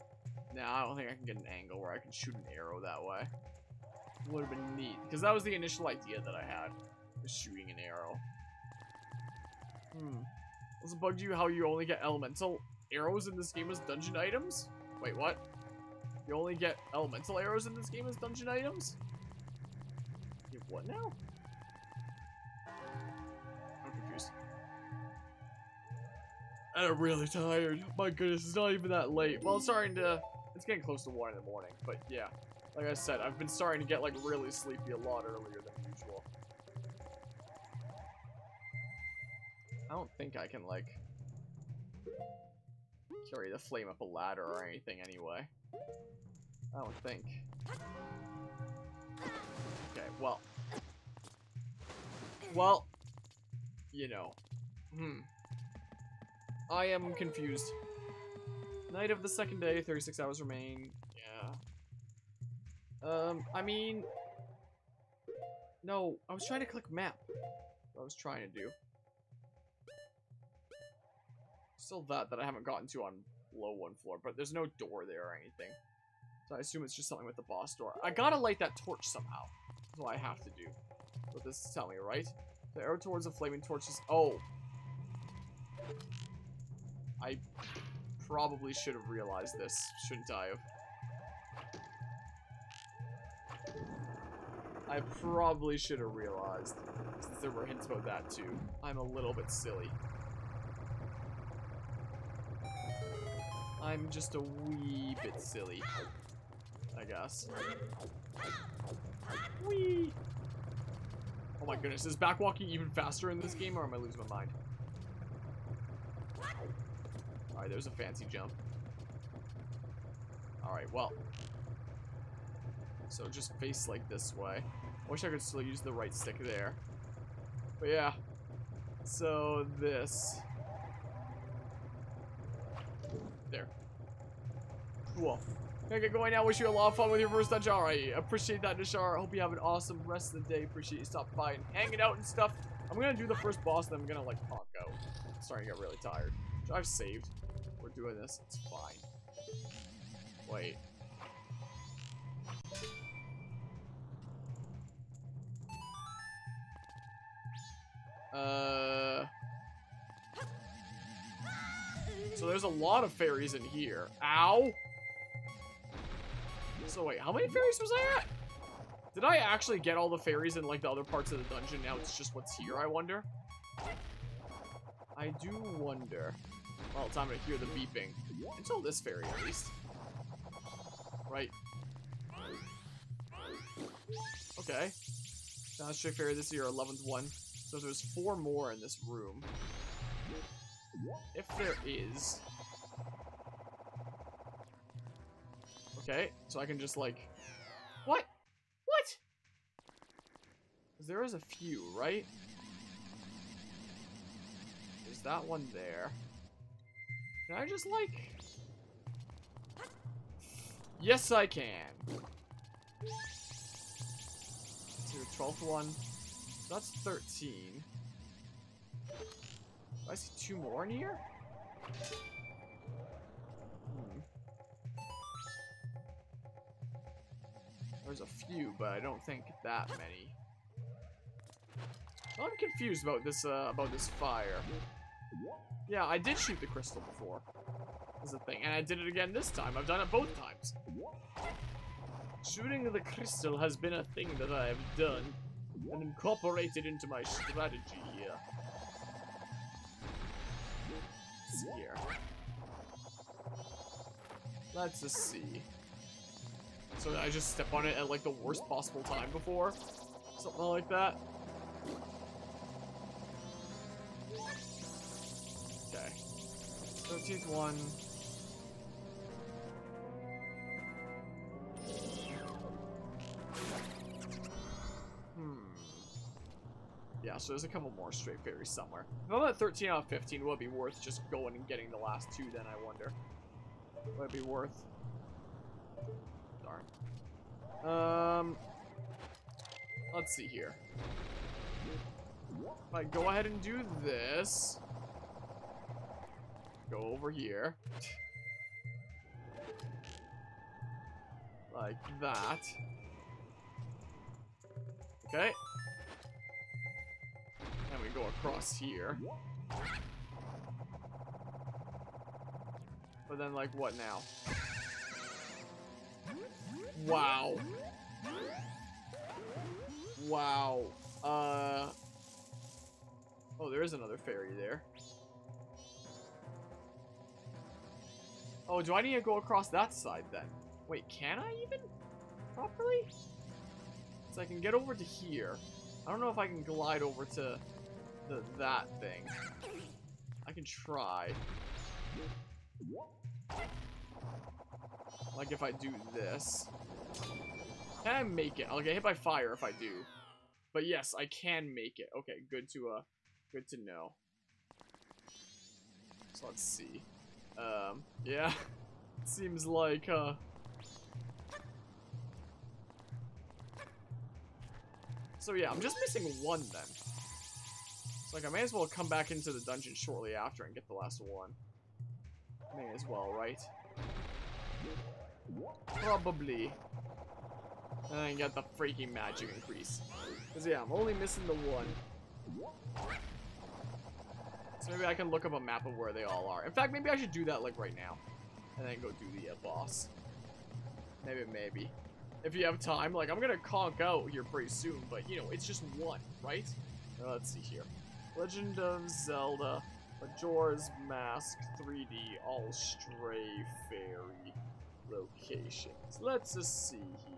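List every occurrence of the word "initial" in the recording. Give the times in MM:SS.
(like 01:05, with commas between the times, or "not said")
00:05.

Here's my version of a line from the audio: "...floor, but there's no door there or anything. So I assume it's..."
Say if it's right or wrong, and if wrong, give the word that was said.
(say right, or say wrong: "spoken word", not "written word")
right.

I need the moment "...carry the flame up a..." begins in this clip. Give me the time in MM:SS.
00:43.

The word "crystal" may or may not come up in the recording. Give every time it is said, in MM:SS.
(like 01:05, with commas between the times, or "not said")
03:56, 04:03.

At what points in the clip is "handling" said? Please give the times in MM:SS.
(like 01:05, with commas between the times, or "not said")
not said.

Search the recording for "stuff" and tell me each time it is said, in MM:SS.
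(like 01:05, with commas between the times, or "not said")
02:22.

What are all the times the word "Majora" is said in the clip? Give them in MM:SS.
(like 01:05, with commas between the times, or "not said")
06:40.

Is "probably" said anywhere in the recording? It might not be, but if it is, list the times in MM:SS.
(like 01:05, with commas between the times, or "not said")
01:28, 01:35, 06:15.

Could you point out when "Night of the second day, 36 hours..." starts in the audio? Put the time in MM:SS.
00:58.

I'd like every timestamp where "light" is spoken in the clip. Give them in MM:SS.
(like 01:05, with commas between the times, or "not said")
01:18.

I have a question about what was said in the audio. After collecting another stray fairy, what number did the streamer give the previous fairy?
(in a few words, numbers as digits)
11th.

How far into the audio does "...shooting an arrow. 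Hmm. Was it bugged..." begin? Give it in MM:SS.
00:07.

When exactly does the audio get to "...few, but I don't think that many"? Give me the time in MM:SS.
03:48.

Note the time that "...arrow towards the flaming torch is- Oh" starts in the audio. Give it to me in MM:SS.
01:22.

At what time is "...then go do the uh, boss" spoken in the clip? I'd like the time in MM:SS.
06:28.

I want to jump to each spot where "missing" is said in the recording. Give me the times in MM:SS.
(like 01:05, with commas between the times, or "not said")
06:06, 06:21.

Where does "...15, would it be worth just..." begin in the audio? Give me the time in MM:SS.
04:40.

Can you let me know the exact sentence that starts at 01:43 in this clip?
I'm just a wee bit silly, I guess.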